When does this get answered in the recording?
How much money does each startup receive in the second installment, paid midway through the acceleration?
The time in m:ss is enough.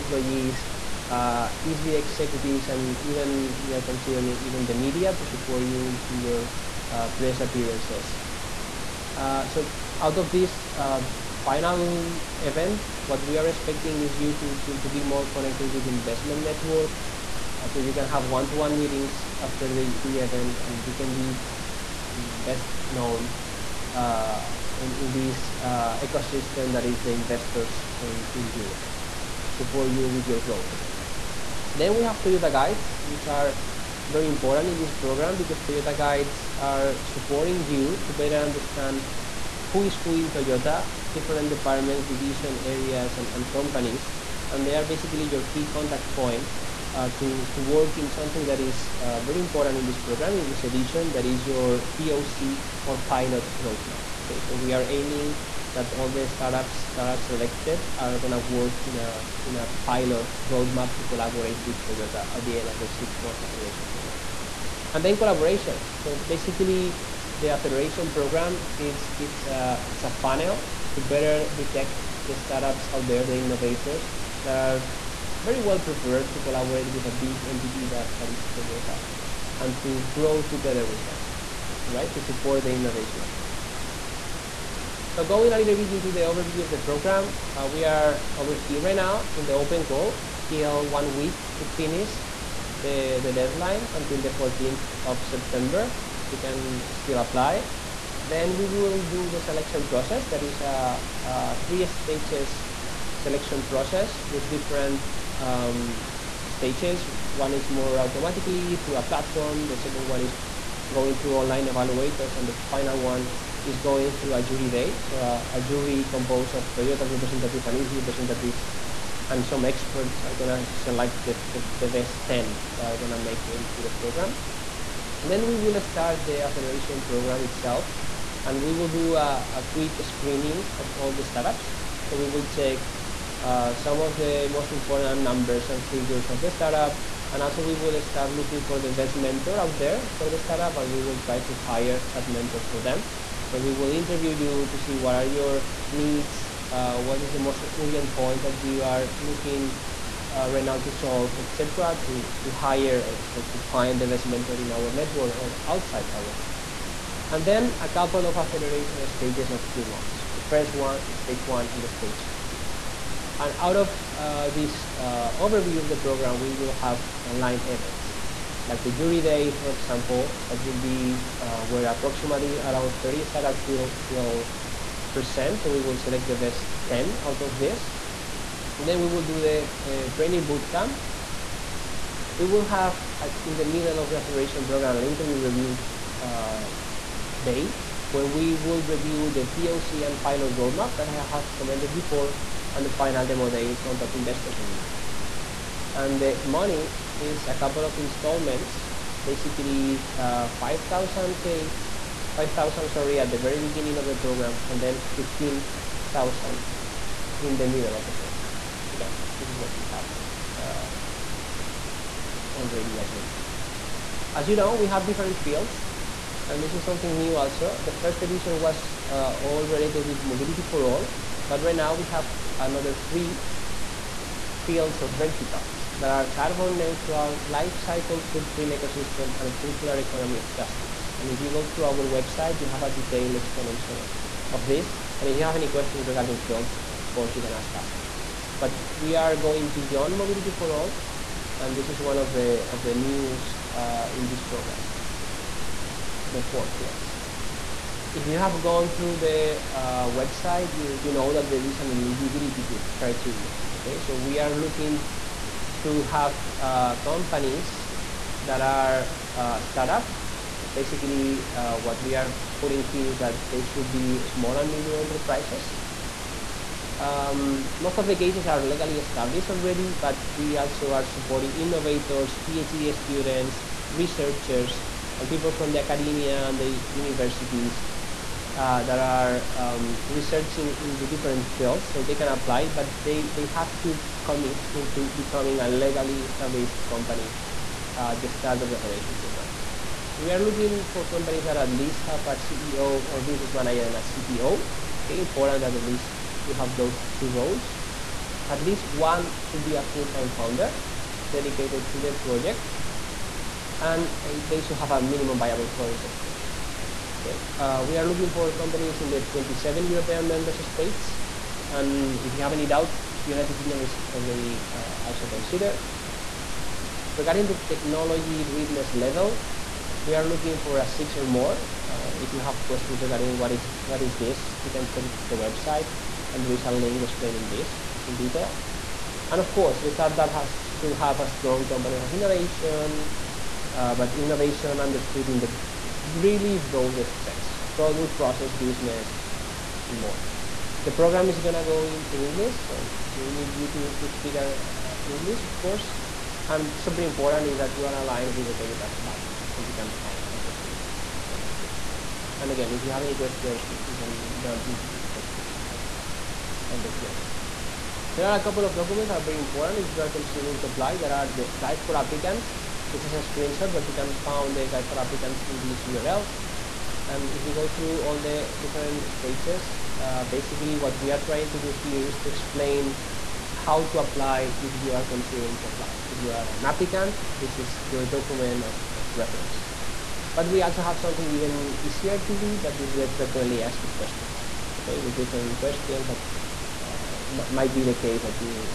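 3:25.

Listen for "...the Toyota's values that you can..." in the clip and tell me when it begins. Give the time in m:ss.
5:48.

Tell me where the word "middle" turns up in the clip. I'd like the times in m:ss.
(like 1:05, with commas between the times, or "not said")
3:03, 3:27.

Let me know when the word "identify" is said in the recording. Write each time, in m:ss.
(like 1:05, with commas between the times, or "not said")
not said.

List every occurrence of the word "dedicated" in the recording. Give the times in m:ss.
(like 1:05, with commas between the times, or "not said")
5:01.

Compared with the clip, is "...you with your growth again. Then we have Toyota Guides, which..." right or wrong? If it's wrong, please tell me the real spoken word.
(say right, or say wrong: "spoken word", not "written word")
right.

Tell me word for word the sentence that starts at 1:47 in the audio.
One is more automatically through a platform.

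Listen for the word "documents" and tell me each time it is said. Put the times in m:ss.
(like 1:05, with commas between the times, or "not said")
5:58, 6:18.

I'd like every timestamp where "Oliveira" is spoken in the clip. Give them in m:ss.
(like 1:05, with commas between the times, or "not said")
not said.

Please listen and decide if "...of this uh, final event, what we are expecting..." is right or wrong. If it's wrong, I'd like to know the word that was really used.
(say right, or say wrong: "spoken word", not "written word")
right.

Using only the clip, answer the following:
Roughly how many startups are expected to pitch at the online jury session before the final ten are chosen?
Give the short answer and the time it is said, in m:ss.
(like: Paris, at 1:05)
30, at 2:53.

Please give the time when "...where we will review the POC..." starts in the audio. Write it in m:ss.
3:08.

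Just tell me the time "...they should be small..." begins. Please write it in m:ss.
4:23.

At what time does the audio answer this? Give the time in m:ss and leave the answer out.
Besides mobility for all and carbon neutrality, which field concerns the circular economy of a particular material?
3:50.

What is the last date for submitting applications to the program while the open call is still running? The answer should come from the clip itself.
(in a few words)
14th of September.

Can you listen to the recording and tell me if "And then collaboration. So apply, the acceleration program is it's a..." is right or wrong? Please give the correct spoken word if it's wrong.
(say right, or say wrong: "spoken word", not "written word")
wrong: "basically", not "apply".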